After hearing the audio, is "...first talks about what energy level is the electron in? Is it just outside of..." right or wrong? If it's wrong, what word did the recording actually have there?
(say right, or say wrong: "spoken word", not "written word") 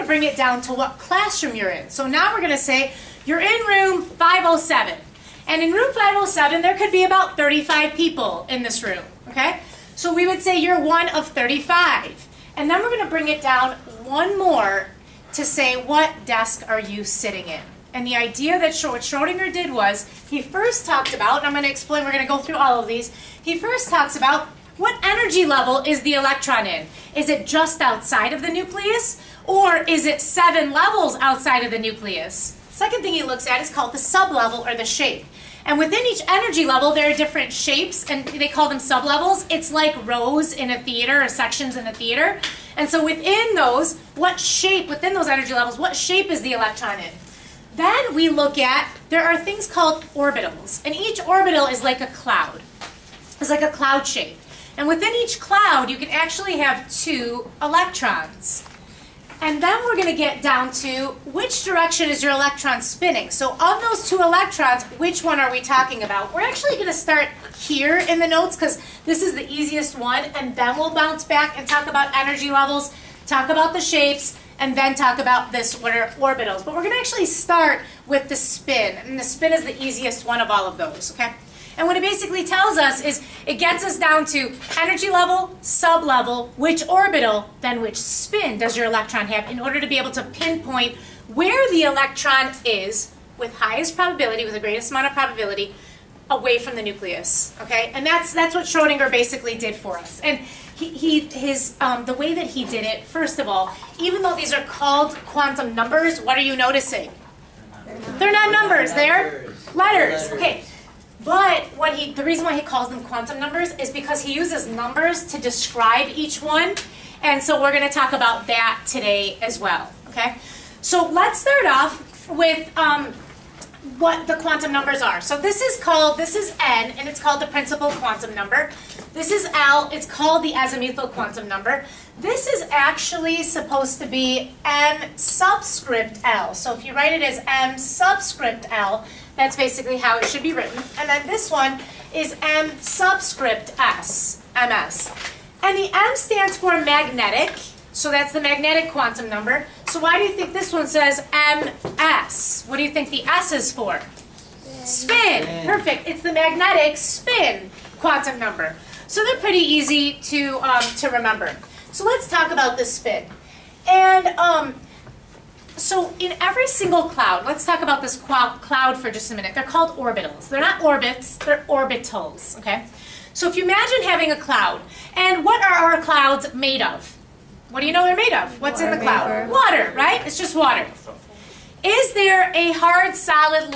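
right.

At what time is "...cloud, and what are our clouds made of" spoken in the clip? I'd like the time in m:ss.
2:54.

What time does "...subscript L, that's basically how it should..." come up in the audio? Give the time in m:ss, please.
2:17.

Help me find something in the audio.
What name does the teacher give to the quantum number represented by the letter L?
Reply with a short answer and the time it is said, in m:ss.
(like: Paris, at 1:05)
azimuthal quantum number, at 2:10.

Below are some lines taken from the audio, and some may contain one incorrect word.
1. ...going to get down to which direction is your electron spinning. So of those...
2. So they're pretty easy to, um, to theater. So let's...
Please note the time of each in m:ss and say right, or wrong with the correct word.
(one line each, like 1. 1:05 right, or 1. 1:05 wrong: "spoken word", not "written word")
1. 0:59 right
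2. 2:39 wrong: "remember", not "theater".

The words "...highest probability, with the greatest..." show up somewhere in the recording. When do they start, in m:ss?
1:33.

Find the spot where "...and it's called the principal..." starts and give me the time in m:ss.
2:06.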